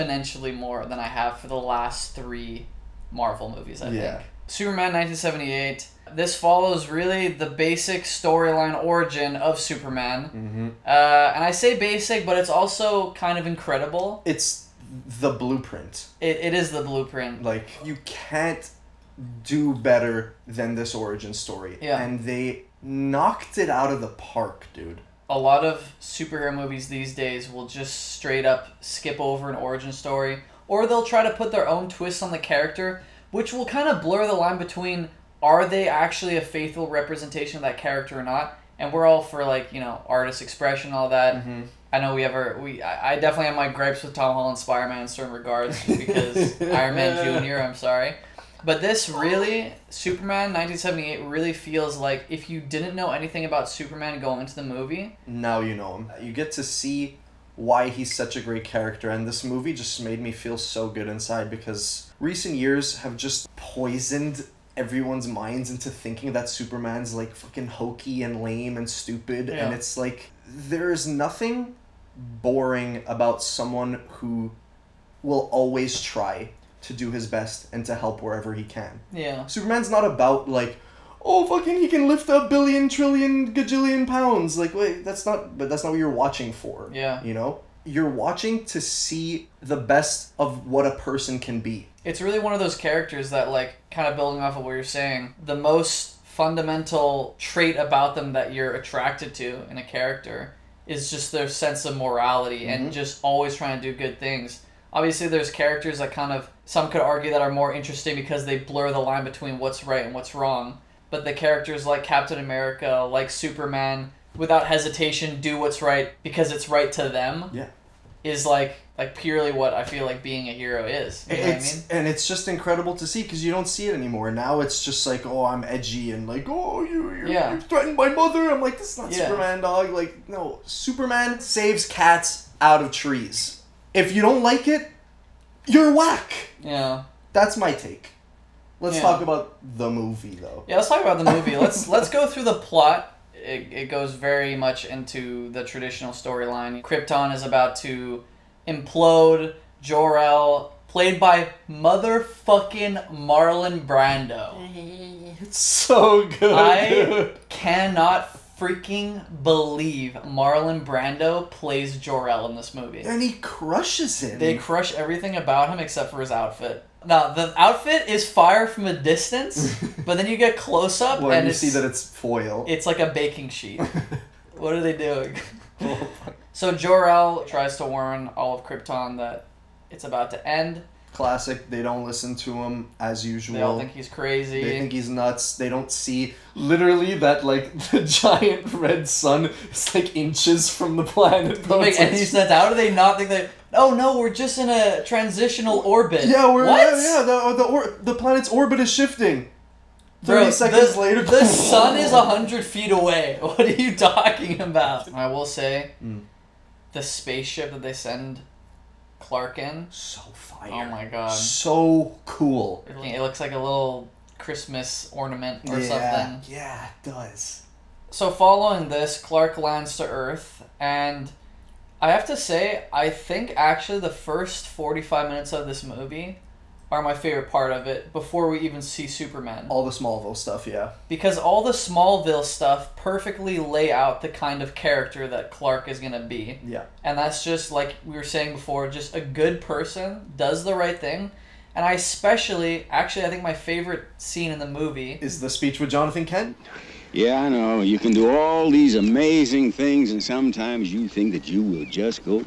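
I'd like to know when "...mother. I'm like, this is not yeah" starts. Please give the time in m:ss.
2:08.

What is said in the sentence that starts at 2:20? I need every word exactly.
Yeah, let's talk about the movie.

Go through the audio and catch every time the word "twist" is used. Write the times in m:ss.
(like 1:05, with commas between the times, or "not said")
0:31.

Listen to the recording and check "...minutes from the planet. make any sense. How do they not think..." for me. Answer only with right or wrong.
wrong.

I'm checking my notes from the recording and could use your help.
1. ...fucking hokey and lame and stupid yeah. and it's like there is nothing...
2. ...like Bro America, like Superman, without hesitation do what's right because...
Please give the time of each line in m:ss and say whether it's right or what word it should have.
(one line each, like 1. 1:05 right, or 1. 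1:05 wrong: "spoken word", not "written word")
1. 1:07 right
2. 1:51 wrong: "Captain", not "Bro".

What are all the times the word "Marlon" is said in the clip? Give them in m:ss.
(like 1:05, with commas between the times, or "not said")
2:33, 2:40.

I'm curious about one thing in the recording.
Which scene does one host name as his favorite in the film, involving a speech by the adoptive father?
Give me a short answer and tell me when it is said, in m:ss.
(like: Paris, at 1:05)
The speech with Jonathan Kent, at 4:05.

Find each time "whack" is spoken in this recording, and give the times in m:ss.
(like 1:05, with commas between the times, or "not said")
2:15.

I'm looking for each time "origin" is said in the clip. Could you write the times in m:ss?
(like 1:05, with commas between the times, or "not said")
0:08, 0:20, 0:29.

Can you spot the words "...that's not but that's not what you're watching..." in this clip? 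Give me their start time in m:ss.
1:25.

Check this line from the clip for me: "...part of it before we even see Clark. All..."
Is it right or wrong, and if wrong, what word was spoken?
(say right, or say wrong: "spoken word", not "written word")
wrong: "Superman", not "Clark".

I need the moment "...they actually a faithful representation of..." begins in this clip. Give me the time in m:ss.
0:35.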